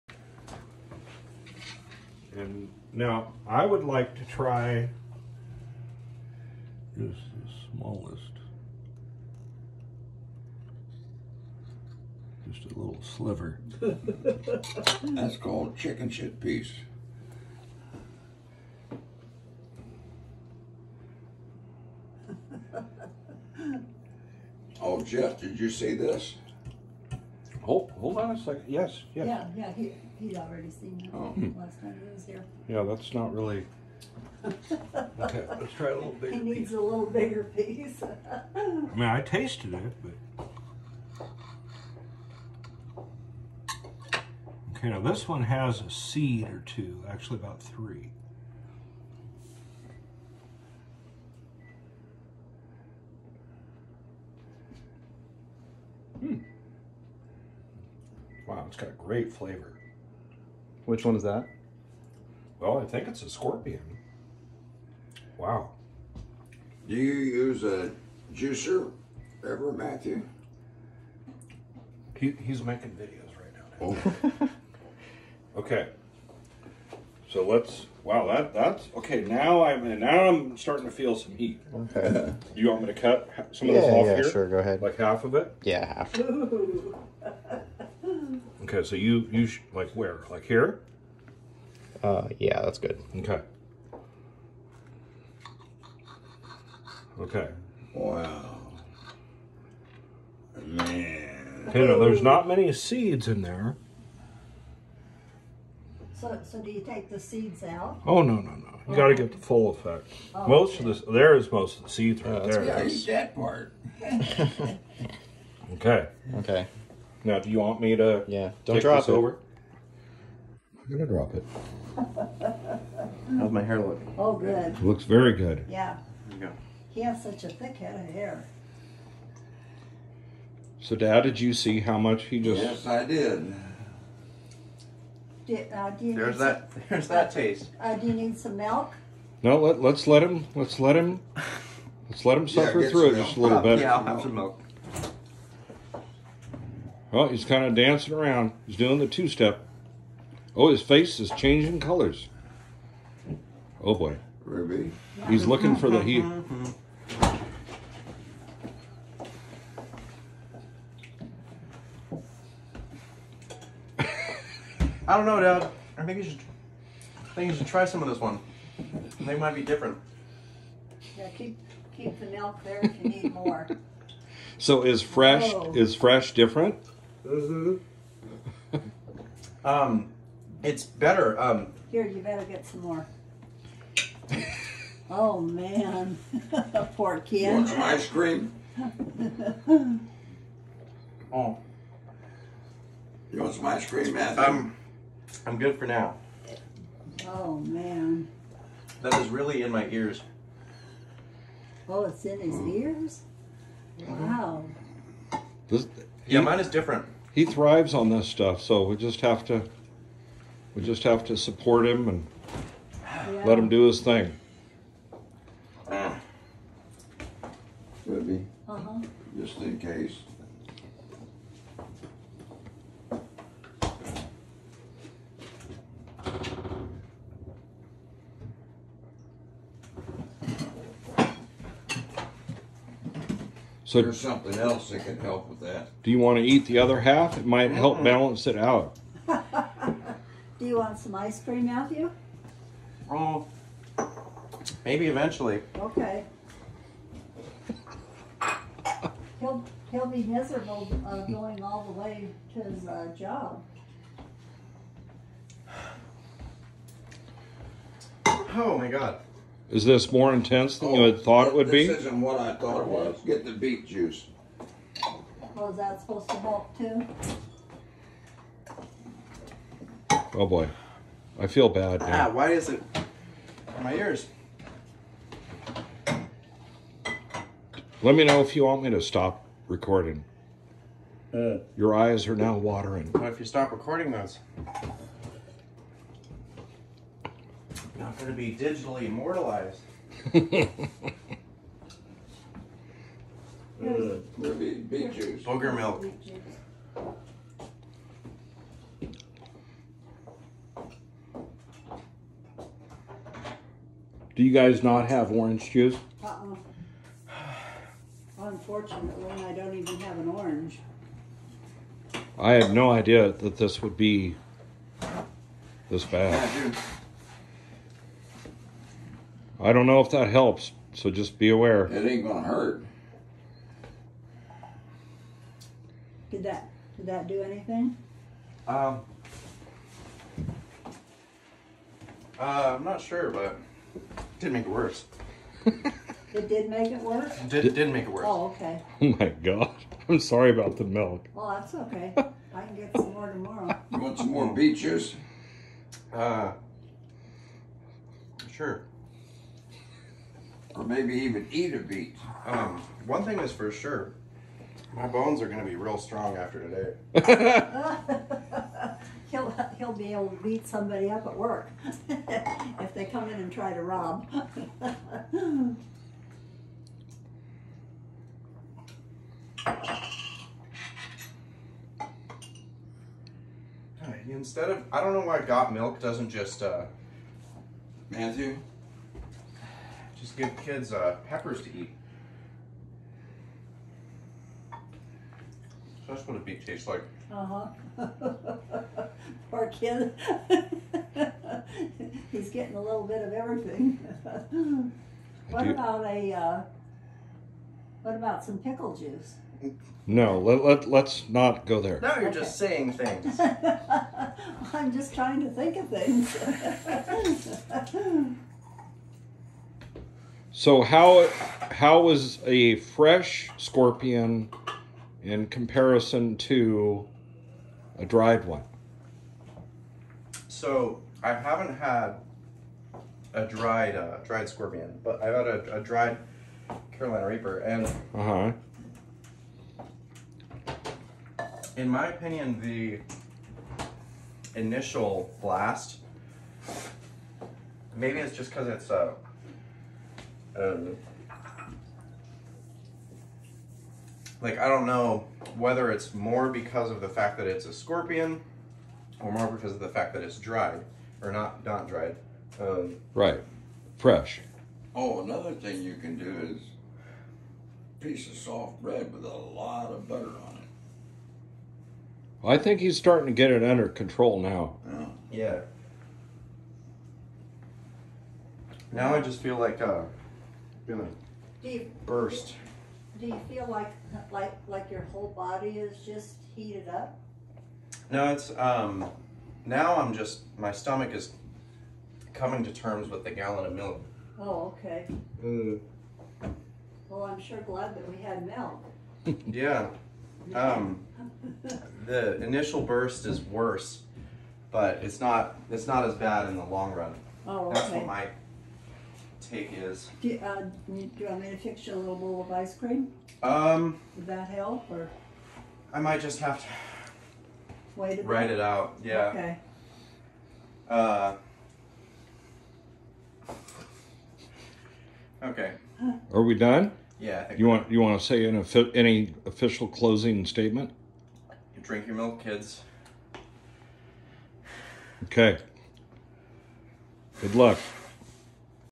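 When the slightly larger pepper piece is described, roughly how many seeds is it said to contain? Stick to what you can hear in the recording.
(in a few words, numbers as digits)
3.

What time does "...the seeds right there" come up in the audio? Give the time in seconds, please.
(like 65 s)
111 s.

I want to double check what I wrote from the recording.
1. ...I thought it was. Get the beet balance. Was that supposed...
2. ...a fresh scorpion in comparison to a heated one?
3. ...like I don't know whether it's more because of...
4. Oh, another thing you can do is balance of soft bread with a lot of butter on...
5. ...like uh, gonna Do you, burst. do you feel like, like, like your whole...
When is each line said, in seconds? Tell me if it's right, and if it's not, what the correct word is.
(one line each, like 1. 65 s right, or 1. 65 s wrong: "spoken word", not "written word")
1. 262 s wrong: "juice", not "balance"
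2. 412 s wrong: "dried", not "heated"
3. 444 s right
4. 454 s wrong: "piece", not "balance"
5. 469 s right.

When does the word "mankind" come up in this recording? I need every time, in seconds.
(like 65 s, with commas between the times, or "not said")
not said.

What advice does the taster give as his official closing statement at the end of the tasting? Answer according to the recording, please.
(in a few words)
Drink your milk.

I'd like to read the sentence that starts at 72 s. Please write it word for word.
He, he's making videos right now.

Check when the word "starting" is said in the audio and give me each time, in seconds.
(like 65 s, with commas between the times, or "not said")
80 s, 462 s.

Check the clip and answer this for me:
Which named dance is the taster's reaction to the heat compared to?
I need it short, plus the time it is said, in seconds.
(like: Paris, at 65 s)
two step, at 149 s.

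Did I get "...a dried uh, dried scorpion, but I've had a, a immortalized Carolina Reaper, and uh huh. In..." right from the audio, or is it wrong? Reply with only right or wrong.
wrong.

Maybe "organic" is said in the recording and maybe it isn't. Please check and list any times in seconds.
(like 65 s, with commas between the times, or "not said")
not said.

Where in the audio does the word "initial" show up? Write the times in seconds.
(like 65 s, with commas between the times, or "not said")
434 s, 492 s.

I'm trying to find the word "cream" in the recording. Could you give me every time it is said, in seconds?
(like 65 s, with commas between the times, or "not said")
188 s, 193 s, 241 s, 502 s.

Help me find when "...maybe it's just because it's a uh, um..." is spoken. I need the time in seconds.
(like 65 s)
437 s.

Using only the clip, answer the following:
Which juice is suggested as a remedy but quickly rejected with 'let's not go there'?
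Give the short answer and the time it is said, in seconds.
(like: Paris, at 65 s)
pickle juice, at 398 s.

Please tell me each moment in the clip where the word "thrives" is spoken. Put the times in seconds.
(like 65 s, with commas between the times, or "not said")
207 s.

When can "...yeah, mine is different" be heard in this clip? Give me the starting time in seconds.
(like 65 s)
206 s.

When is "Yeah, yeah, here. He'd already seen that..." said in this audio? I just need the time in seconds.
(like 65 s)
29 s.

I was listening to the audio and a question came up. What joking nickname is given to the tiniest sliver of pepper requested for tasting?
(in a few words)
chicken shit piece.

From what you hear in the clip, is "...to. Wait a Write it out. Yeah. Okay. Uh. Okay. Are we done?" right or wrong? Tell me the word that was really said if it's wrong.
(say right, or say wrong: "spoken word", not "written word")
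right.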